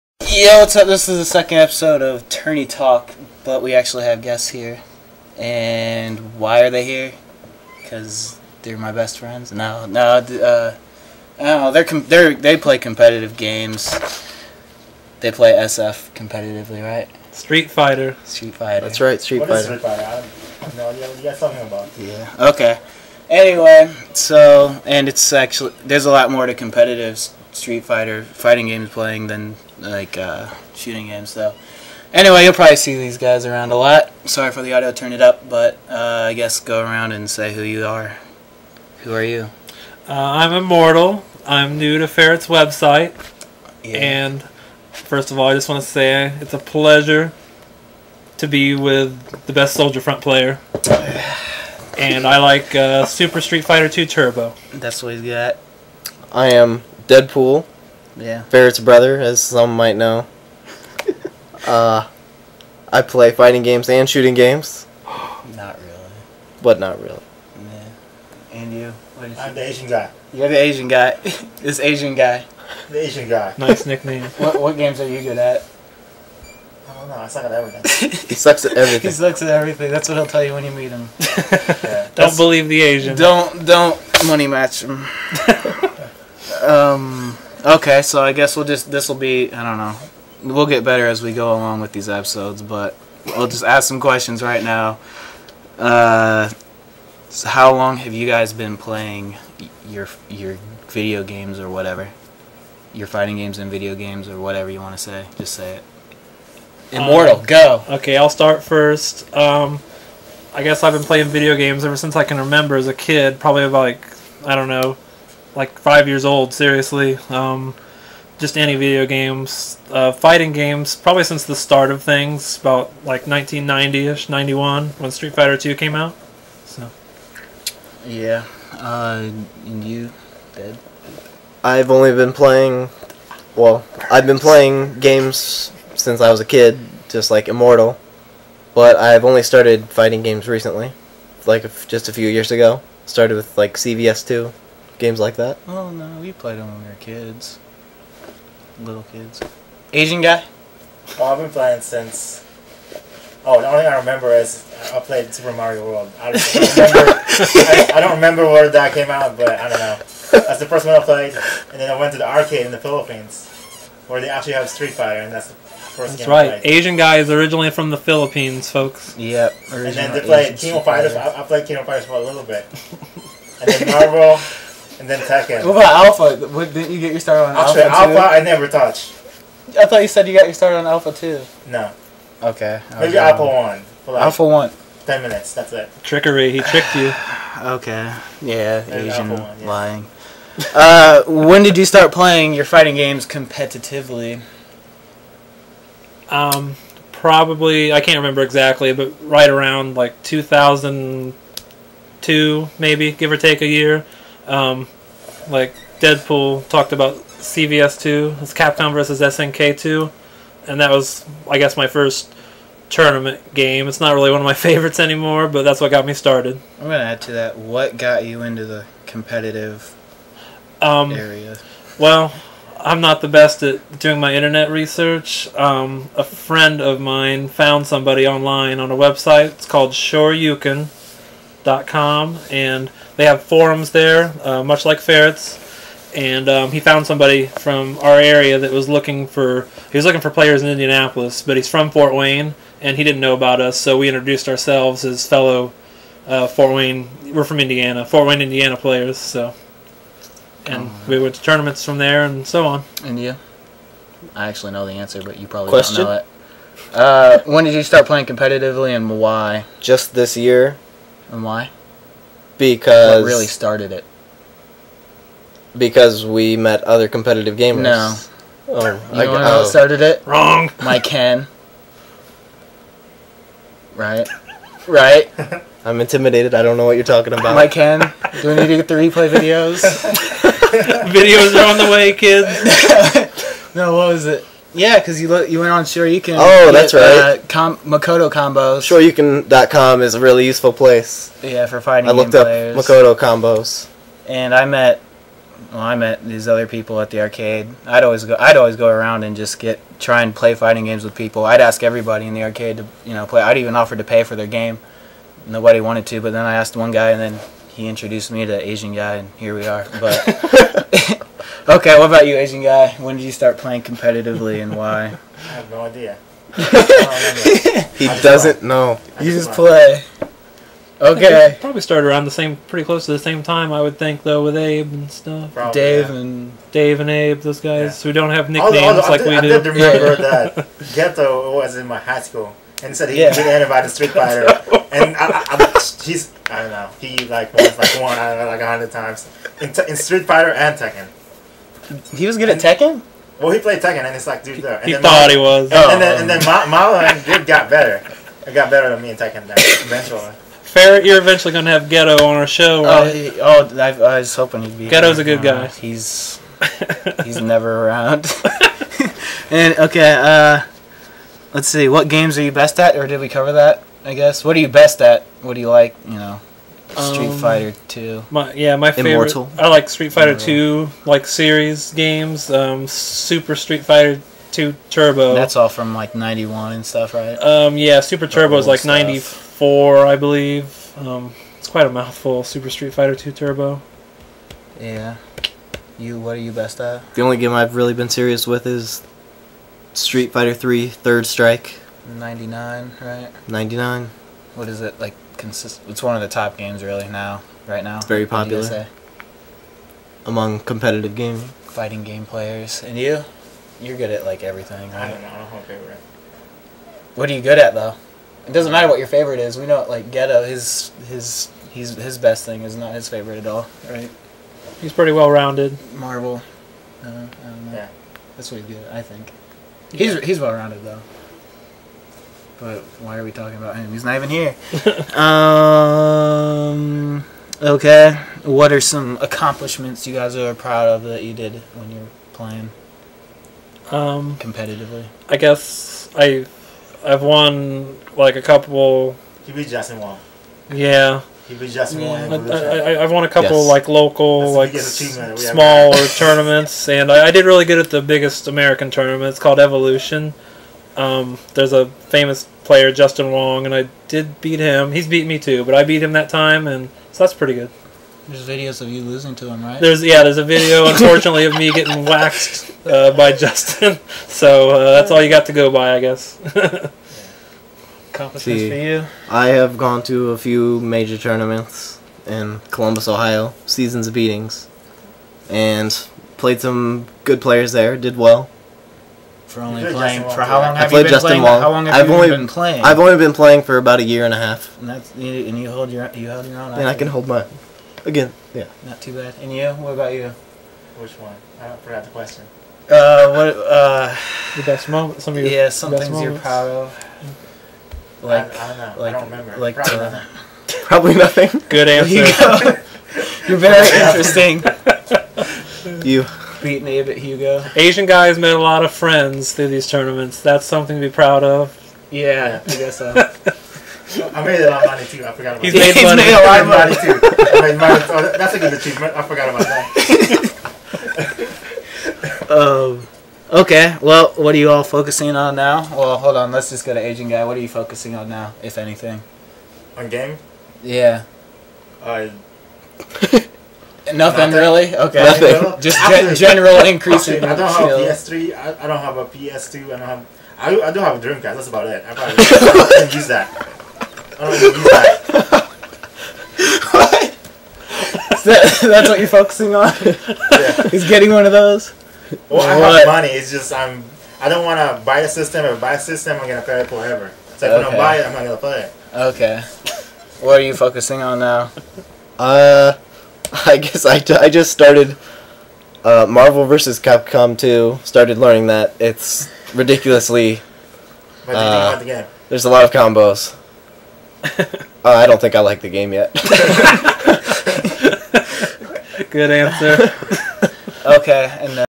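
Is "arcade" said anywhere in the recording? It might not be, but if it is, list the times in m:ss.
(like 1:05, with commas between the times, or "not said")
2:42, 4:57, 5:02.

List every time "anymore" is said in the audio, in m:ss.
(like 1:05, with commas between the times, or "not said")
3:34.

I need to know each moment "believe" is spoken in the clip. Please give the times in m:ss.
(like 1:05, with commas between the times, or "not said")
1:22, 6:20.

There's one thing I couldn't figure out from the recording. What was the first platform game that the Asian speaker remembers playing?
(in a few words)
Super Mario World.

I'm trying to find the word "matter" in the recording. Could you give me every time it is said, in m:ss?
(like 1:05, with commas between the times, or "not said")
6:48.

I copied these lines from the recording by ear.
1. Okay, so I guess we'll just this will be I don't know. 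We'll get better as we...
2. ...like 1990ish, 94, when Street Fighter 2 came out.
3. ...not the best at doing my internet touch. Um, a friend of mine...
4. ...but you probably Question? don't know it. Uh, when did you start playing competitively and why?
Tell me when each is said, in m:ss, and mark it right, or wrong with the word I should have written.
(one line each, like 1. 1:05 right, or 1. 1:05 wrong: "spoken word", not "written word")
1. 1:27 right
2. 2:03 wrong: "91", not "94"
3. 3:42 wrong: "research", not "touch"
4. 4:15 right.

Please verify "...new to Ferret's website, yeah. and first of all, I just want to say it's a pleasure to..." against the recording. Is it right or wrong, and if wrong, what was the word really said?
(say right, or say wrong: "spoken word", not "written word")
right.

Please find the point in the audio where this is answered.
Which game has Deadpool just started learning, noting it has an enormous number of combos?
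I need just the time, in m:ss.
9:26.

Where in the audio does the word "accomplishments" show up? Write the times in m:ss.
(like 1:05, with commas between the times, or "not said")
7:09.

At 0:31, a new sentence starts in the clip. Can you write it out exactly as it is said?
So anyway, you'll probably see these guys around a lot.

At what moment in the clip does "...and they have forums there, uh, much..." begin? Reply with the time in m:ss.
3:52.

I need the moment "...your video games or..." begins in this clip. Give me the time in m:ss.
1:40.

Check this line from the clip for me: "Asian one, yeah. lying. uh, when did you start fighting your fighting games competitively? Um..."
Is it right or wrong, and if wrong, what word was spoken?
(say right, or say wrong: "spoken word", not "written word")
wrong: "playing", not "fighting".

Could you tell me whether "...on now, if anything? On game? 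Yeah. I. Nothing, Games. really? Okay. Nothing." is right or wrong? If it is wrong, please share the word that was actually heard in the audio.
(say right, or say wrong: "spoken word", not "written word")
wrong: "Nothing", not "Games".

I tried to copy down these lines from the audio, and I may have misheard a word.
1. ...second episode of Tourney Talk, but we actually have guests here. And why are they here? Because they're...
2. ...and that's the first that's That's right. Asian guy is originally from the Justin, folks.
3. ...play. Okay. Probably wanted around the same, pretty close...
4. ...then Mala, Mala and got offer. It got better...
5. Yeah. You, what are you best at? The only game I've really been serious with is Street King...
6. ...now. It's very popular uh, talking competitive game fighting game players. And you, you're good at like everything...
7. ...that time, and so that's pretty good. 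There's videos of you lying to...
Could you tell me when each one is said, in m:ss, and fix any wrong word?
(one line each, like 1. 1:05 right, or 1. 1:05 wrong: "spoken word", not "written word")
1. 0:01 right
2. 2:45 wrong: "Philippines", not "Justin"
3. 5:19 wrong: "started", not "wanted"
4. 5:46 wrong: "better", not "offer"
5. 6:24 wrong: "Fighter", not "King"
6. 6:37 wrong: "among", not "talking"
7. 7:36 wrong: "losing", not "lying".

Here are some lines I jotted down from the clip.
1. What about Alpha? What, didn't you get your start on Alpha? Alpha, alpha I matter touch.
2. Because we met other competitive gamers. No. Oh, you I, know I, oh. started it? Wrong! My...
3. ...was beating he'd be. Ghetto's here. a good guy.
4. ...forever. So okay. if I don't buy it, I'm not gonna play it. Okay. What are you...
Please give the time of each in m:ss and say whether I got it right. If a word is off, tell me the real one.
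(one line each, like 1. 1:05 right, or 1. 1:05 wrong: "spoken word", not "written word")
1. 2:55 wrong: "never", not "matter"
2. 4:25 right
3. 5:54 wrong: "hoping", not "beating"
4. 9:16 right.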